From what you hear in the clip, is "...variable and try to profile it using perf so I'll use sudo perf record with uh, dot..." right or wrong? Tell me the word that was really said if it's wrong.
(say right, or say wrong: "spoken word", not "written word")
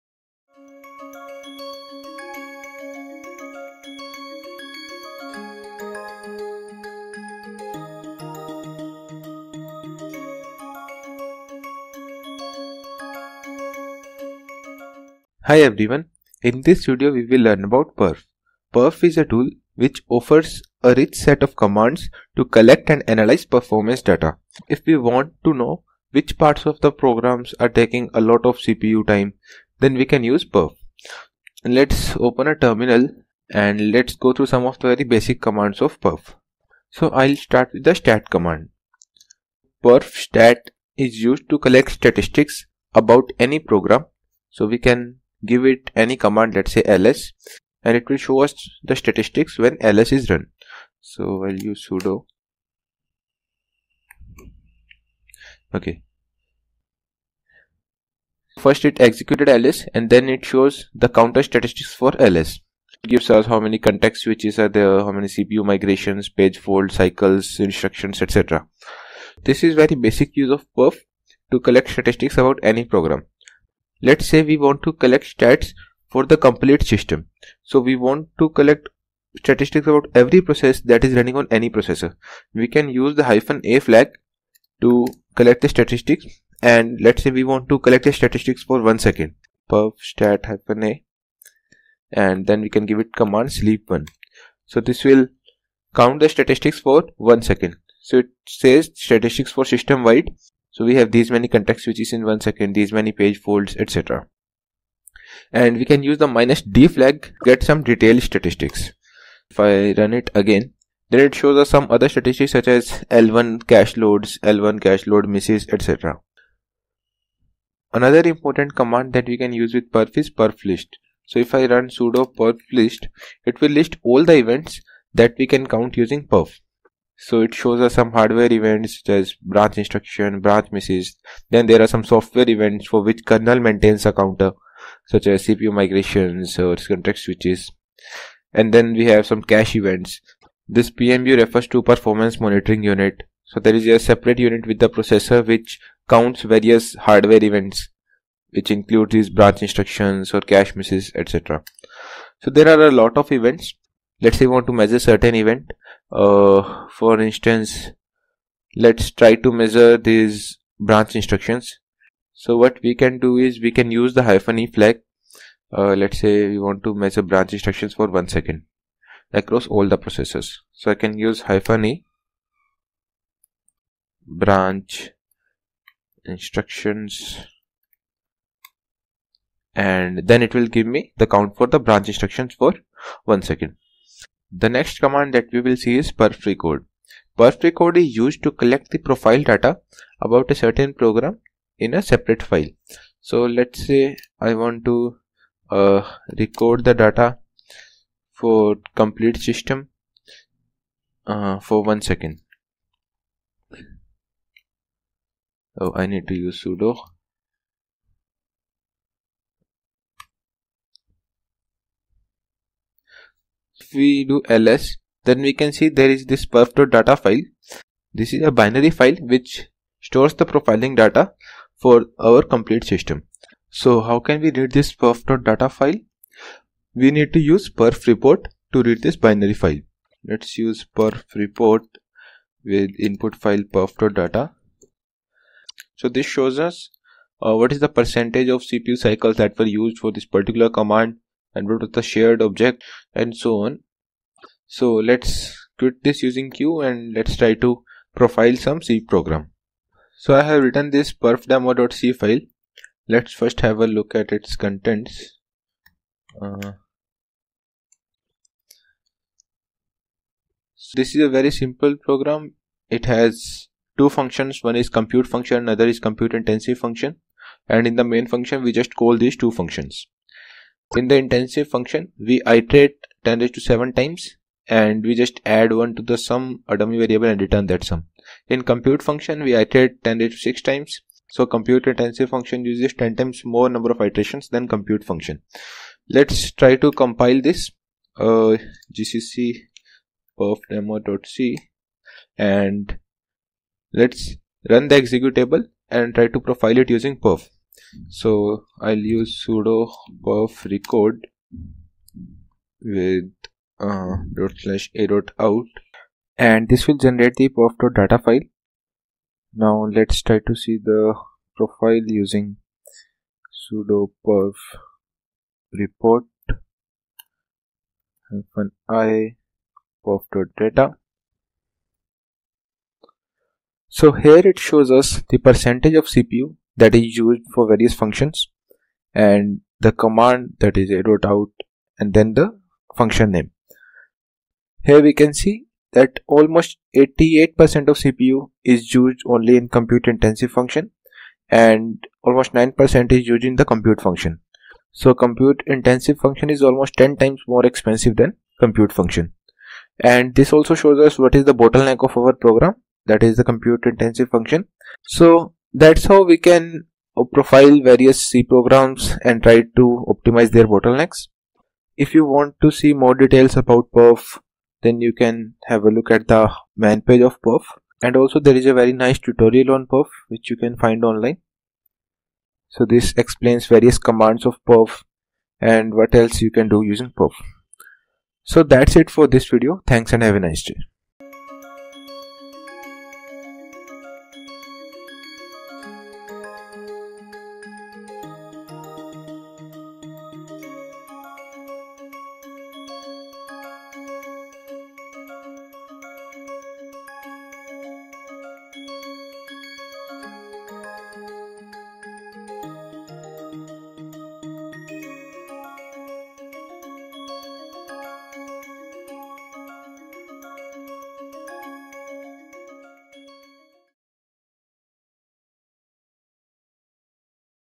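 wrong: "executable", not "variable".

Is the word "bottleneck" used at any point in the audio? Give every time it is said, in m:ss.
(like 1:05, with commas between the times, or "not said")
5:51, 6:00.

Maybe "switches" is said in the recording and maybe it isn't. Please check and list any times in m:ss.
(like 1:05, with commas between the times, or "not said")
1:04, 1:41, 2:17.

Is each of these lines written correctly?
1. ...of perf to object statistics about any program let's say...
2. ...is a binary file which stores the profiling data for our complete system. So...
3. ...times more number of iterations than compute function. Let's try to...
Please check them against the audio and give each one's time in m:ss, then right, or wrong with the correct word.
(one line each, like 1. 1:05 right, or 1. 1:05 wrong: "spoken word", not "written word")
1. 1:10 wrong: "collect", not "object"
2. 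3:38 right
3. 4:43 right.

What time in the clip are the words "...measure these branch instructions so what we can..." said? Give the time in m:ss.
2:39.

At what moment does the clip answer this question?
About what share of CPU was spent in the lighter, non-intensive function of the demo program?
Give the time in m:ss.
5:42.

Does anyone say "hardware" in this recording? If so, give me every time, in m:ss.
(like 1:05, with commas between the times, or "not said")
2:08, 2:27.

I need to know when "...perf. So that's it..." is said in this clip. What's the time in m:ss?
6:17.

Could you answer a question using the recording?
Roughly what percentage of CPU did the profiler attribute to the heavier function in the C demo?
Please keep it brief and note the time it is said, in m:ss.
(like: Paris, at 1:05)
88%, at 5:36.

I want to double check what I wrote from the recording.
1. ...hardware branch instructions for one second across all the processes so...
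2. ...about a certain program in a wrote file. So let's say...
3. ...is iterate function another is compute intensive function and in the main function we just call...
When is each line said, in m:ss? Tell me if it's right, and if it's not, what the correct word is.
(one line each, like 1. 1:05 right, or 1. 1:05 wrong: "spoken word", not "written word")
1. 2:46 wrong: "measure", not "hardware"
2. 3:10 wrong: "separate", not "wrote"
3. 4:24 wrong: "compute", not "iterate".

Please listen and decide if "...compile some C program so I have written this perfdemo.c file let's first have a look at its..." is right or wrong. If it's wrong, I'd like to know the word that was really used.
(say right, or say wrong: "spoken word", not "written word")
wrong: "profile", not "compile".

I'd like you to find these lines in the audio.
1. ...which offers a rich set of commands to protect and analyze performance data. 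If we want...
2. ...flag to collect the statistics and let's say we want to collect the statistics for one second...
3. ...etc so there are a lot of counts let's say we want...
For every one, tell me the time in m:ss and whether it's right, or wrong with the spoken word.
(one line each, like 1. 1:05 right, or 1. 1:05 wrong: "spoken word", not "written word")
1. 0:19 wrong: "collect", not "protect"
2. 1:23 right
3. 2:31 wrong: "events", not "counts".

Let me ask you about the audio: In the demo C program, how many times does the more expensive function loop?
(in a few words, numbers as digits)
10^7.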